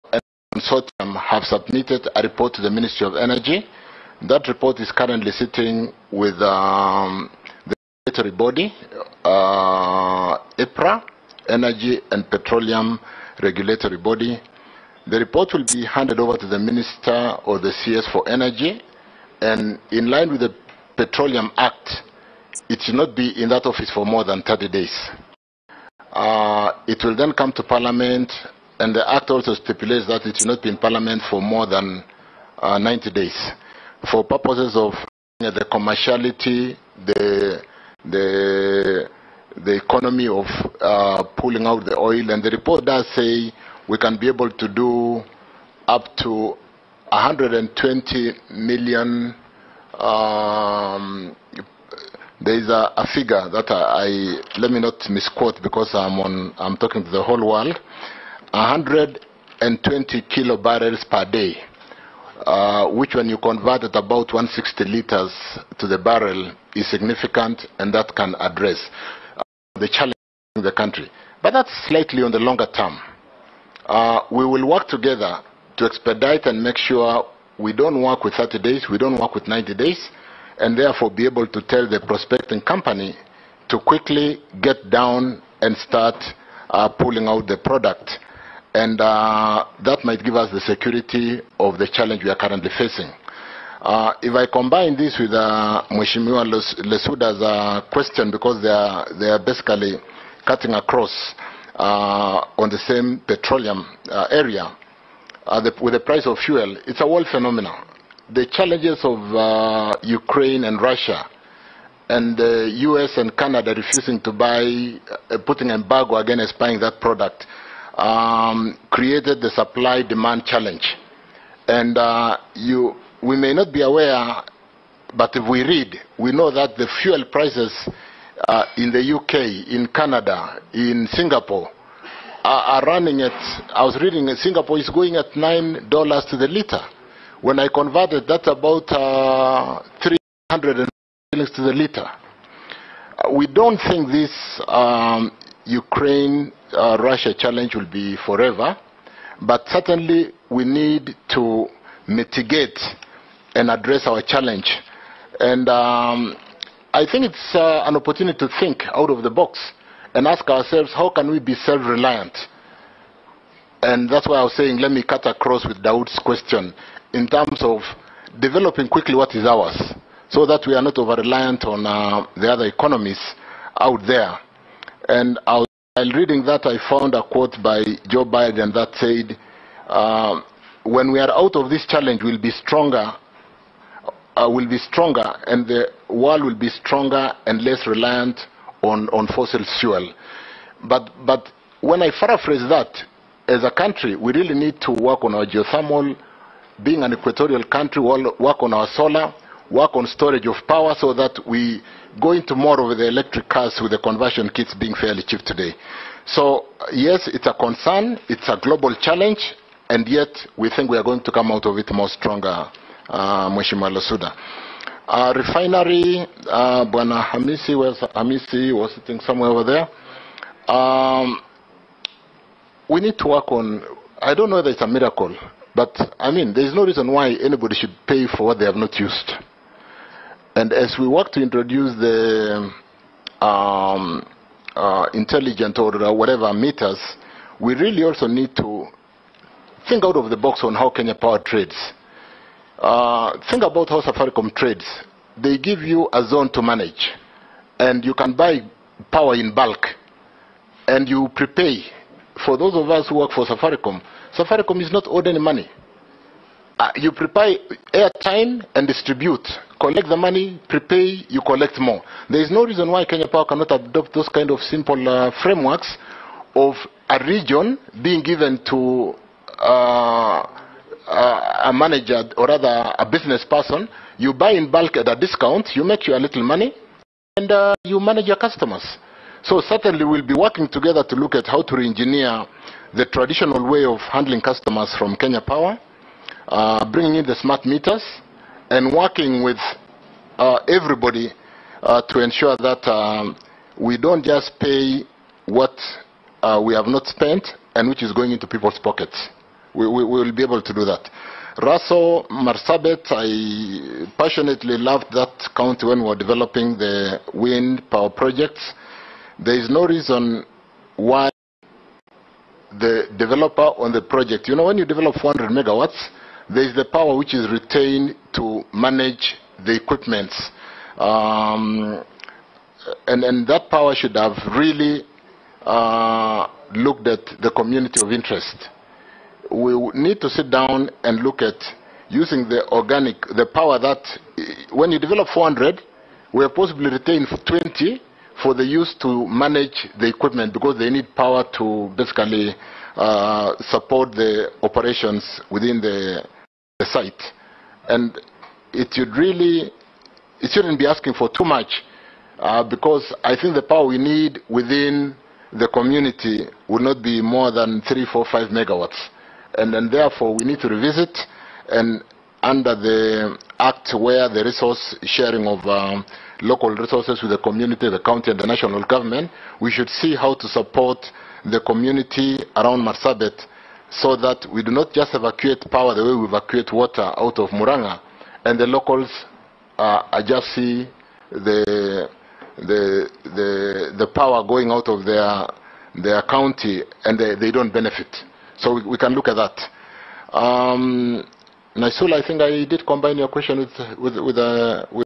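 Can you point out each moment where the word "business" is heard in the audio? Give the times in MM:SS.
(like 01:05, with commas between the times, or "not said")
04:33.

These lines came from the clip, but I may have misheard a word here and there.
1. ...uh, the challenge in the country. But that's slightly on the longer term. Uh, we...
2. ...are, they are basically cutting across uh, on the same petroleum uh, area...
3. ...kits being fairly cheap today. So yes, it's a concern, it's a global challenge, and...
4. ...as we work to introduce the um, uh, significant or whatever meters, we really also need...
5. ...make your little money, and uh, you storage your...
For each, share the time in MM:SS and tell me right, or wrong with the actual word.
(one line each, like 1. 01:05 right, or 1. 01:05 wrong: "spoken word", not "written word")
1. 01:09 right
2. 01:38 right
3. 03:24 right
4. 03:50 wrong: "intelligent", not "significant"
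5. 04:35 wrong: "manage", not "storage".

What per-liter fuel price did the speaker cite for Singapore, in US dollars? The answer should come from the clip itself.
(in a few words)
$9.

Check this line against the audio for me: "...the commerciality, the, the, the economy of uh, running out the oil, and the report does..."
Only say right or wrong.
wrong.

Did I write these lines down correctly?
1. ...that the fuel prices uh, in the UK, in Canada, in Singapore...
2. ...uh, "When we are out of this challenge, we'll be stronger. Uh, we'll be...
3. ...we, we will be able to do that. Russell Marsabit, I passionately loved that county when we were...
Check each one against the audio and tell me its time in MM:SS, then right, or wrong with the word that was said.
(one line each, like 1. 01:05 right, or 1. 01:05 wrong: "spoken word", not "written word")
1. 02:06 right
2. 02:59 right
3. 04:59 right.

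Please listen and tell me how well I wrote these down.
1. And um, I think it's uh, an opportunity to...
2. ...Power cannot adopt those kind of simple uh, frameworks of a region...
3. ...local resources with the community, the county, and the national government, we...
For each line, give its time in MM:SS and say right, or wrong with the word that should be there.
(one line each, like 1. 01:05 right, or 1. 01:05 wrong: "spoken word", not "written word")
1. 02:35 right
2. 04:23 right
3. 06:06 right.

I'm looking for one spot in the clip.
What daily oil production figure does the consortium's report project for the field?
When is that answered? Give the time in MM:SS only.
00:58.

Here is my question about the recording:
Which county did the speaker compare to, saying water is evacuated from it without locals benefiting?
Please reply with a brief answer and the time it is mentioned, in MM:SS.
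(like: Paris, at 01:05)
Muranga, at 06:17.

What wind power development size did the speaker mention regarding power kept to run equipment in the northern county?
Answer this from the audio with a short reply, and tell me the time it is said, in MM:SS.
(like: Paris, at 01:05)
400 megawatts, at 05:15.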